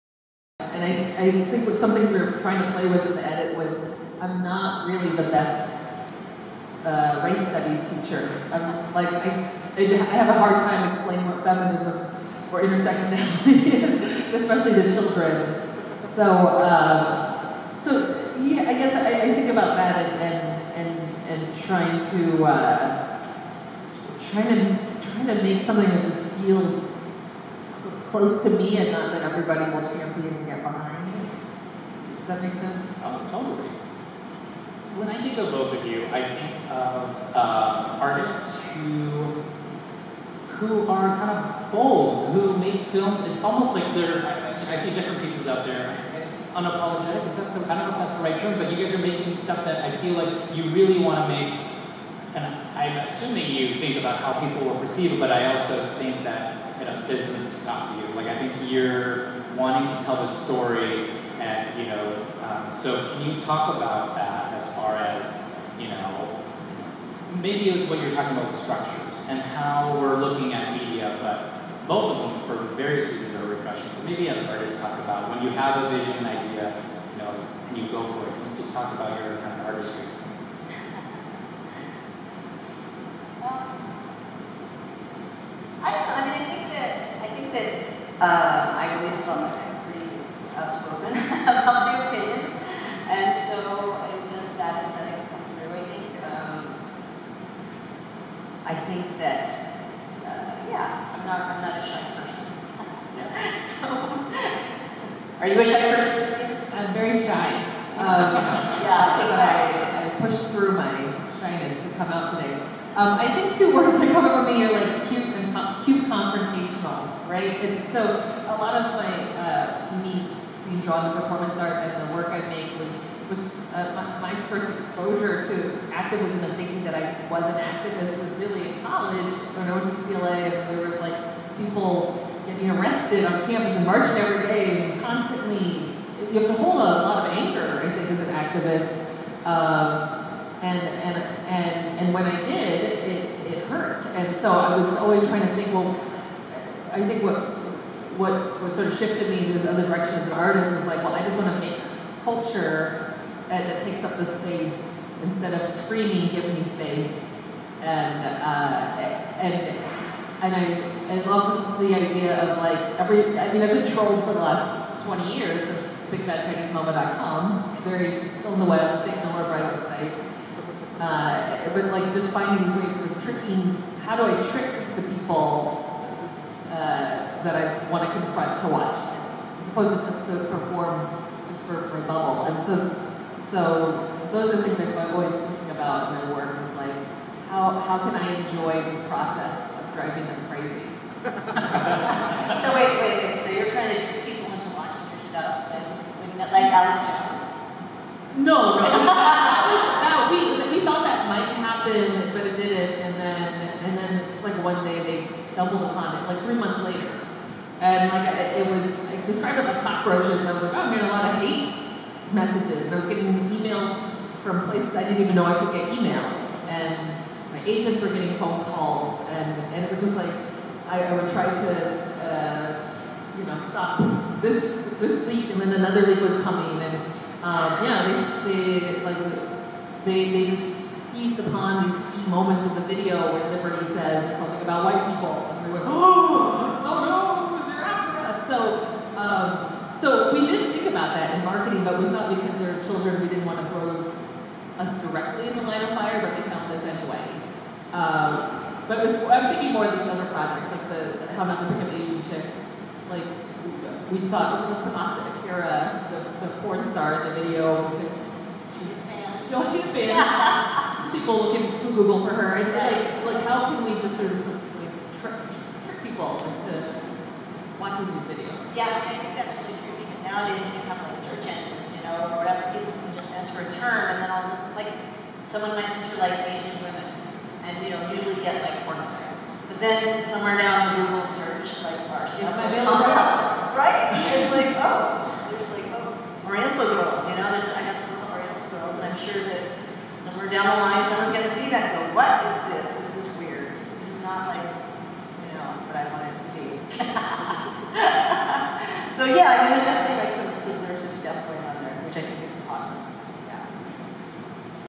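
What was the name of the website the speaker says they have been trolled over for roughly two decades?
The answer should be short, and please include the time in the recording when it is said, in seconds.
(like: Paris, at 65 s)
BigFatChineseMama.com, at 166 s.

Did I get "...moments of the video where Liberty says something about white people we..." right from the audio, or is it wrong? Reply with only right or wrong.
right.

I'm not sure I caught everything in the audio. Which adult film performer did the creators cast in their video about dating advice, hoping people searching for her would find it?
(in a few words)
Asa Akira.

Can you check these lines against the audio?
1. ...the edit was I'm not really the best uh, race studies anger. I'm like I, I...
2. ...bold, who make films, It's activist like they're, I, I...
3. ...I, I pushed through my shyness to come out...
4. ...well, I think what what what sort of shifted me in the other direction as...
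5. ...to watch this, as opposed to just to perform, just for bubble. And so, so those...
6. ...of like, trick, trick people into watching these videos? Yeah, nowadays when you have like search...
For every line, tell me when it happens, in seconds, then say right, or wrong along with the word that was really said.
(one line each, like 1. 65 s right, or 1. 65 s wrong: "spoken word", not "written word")
1. 3 s wrong: "teacher", not "anger"
2. 41 s wrong: "almost", not "activist"
3. 109 s right
4. 145 s right
5. 178 s right
6. 264 s right.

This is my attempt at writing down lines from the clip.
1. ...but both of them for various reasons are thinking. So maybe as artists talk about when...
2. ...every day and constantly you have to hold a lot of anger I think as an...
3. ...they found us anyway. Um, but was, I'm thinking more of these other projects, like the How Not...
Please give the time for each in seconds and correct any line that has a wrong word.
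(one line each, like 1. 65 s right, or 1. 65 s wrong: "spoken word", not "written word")
1. 71 s wrong: "refreshing", not "thinking"
2. 134 s right
3. 246 s right.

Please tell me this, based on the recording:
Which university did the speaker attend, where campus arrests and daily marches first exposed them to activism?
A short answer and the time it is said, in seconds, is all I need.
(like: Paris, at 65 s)
UCLA, at 130 s.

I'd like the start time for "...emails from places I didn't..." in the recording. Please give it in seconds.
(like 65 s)
213 s.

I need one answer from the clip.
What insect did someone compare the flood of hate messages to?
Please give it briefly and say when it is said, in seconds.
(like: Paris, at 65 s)
Cockroaches, at 209 s.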